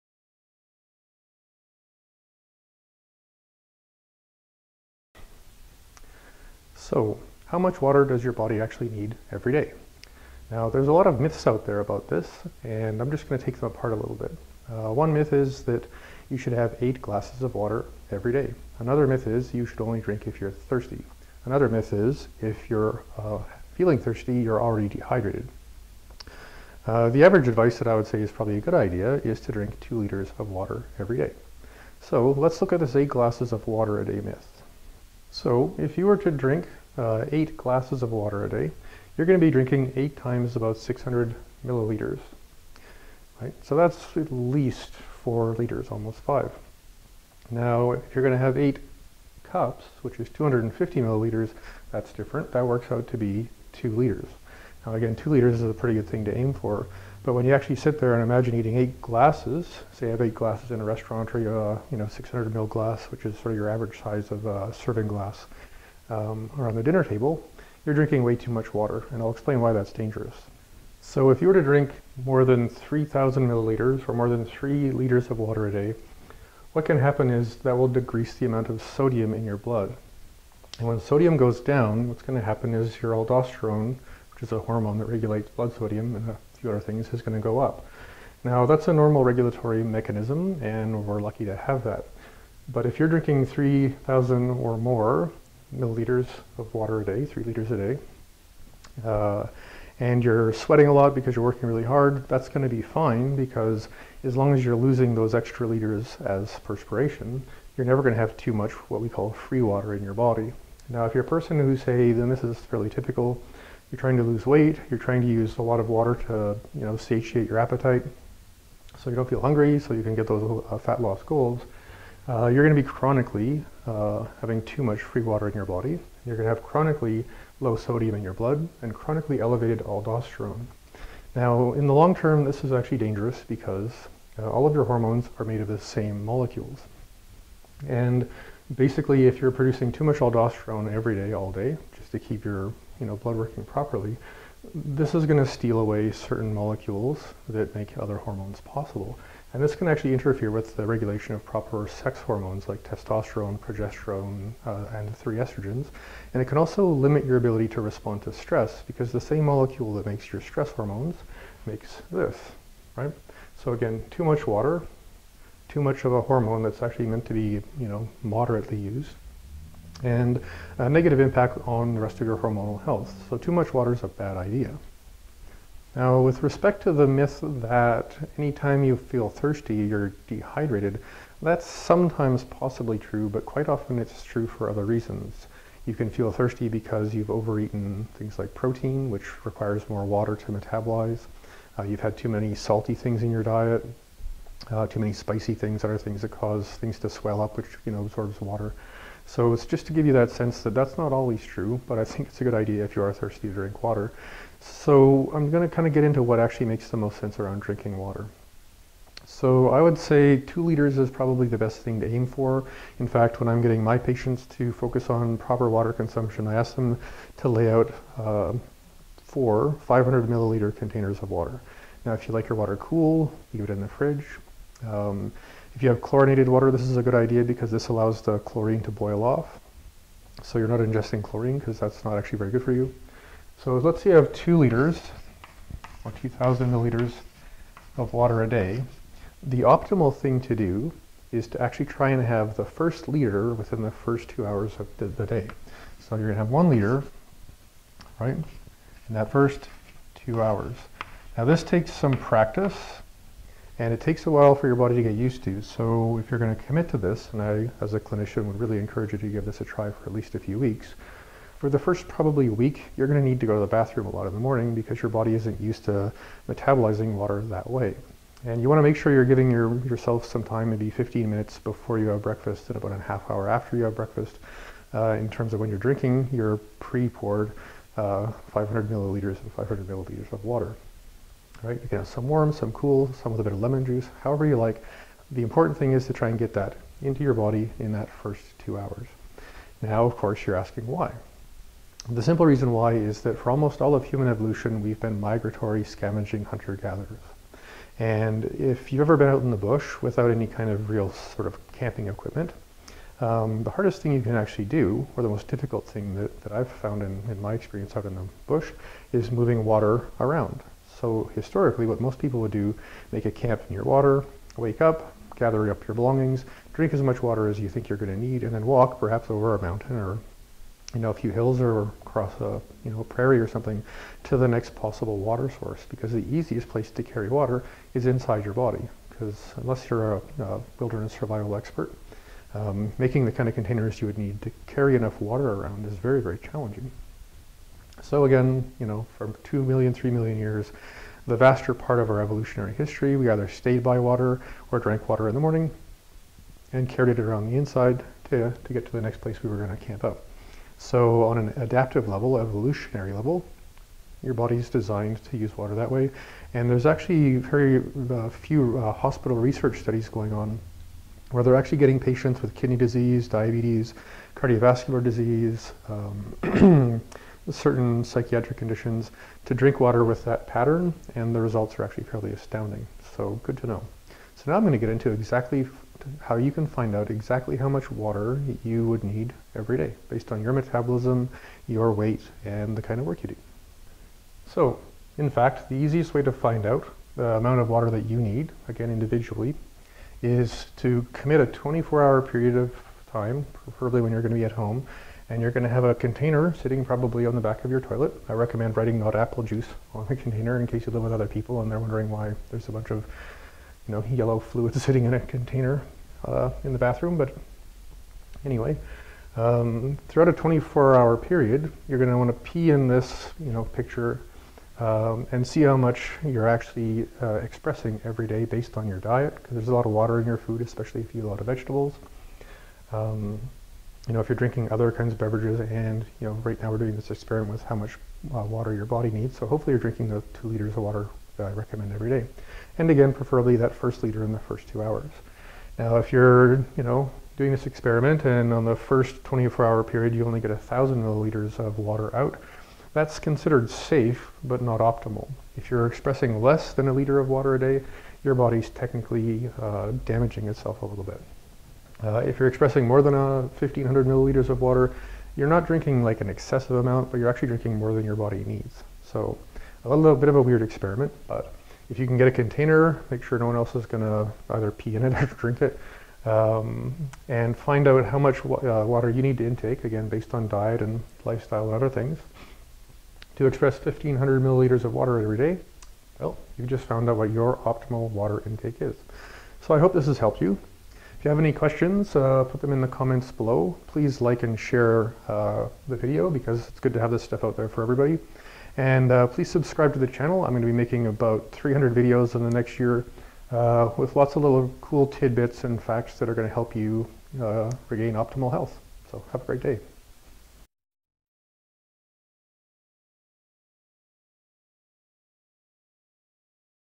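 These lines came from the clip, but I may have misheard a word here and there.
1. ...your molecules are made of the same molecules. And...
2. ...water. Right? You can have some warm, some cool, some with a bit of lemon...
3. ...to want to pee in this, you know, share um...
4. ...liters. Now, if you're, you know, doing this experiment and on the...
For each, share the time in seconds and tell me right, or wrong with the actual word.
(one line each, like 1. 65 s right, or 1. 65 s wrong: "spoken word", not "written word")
1. 134 s wrong: "hormones", not "molecules"
2. 280 s right
3. 412 s wrong: "picture", not "share"
4. 434 s wrong: "hours", not "liters".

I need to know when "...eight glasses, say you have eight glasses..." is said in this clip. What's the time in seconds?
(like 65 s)
58 s.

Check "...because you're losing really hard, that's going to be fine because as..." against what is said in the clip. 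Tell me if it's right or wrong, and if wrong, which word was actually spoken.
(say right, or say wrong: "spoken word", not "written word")
wrong: "working", not "losing".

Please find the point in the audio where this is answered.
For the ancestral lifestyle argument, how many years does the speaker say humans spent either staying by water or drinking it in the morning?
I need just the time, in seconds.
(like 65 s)
339 s.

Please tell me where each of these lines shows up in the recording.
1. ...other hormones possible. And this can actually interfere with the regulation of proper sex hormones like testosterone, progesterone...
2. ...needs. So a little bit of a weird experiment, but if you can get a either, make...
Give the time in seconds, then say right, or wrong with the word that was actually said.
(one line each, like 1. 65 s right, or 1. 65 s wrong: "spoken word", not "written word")
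1. 147 s right
2. 458 s wrong: "container", not "either".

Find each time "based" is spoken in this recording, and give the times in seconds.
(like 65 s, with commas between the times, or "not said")
380 s, 418 s, 470 s.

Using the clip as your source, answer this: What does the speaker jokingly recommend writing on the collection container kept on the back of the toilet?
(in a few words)
not apple juice.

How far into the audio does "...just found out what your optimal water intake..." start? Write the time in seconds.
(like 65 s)
476 s.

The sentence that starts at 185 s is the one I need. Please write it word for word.
You can feel thirsty because you've overeaten things like protein, which requires more water to metabolize.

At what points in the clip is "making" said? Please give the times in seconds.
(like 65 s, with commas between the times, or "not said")
332 s, 490 s.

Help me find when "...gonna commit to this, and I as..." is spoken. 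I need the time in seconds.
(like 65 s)
256 s.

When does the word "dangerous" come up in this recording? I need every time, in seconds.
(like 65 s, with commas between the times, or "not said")
69 s, 132 s.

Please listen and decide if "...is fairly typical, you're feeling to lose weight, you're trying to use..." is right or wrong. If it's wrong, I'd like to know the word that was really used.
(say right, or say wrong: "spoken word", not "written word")
wrong: "trying", not "feeling".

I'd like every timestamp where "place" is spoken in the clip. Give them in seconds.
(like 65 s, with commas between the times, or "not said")
326 s, 349 s.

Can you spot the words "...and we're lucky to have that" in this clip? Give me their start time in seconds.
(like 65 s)
90 s.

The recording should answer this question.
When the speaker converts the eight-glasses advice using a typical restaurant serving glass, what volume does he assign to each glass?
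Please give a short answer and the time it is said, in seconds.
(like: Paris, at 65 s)
600 ml, at 40 s.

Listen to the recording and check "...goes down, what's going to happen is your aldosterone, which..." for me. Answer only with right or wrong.
right.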